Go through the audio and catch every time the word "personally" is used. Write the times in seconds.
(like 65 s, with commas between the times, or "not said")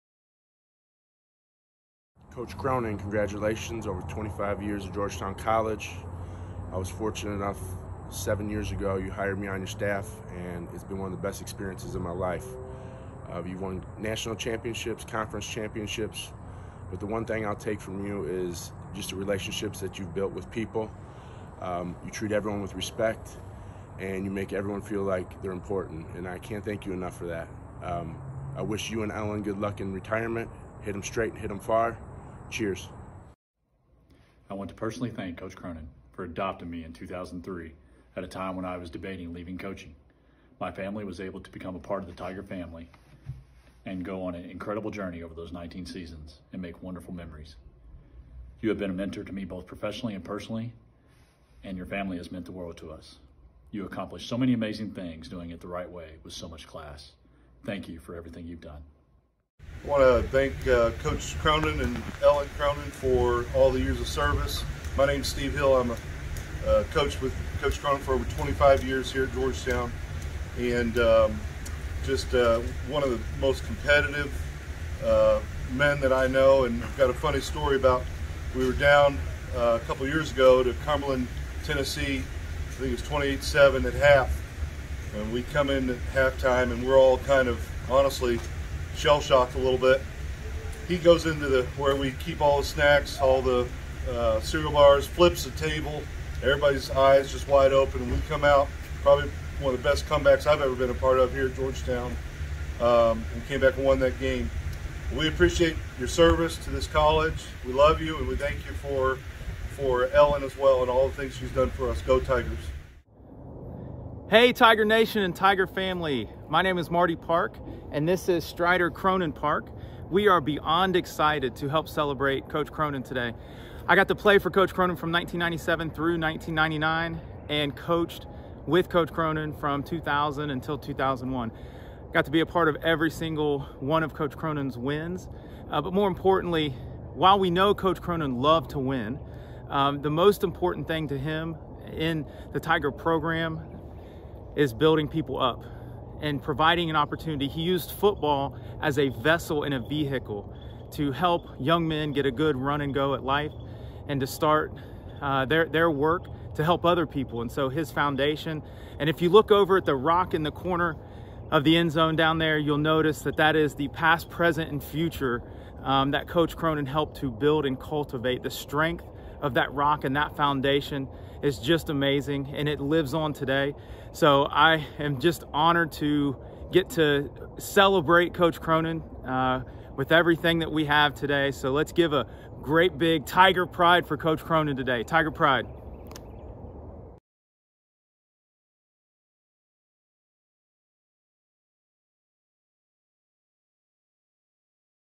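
34 s, 50 s.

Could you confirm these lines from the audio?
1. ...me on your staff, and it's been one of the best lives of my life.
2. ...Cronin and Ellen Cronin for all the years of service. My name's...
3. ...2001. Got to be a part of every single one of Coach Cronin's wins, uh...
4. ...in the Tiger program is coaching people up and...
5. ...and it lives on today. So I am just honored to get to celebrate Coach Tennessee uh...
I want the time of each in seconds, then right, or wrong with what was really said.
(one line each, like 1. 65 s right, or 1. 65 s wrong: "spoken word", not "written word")
1. 9 s wrong: "experiences", not "lives"
2. 61 s right
3. 130 s right
4. 141 s wrong: "building", not "coaching"
5. 172 s wrong: "Cronin", not "Tennessee".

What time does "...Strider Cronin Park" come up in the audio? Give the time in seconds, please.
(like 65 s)
118 s.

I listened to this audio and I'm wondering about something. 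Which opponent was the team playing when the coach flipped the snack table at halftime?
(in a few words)
Cumberland.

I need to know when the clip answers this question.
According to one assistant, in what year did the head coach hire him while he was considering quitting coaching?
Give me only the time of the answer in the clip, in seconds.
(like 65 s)
36 s.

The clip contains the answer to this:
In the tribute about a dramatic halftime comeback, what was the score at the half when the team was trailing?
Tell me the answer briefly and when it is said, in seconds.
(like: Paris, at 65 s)
28-7, at 83 s.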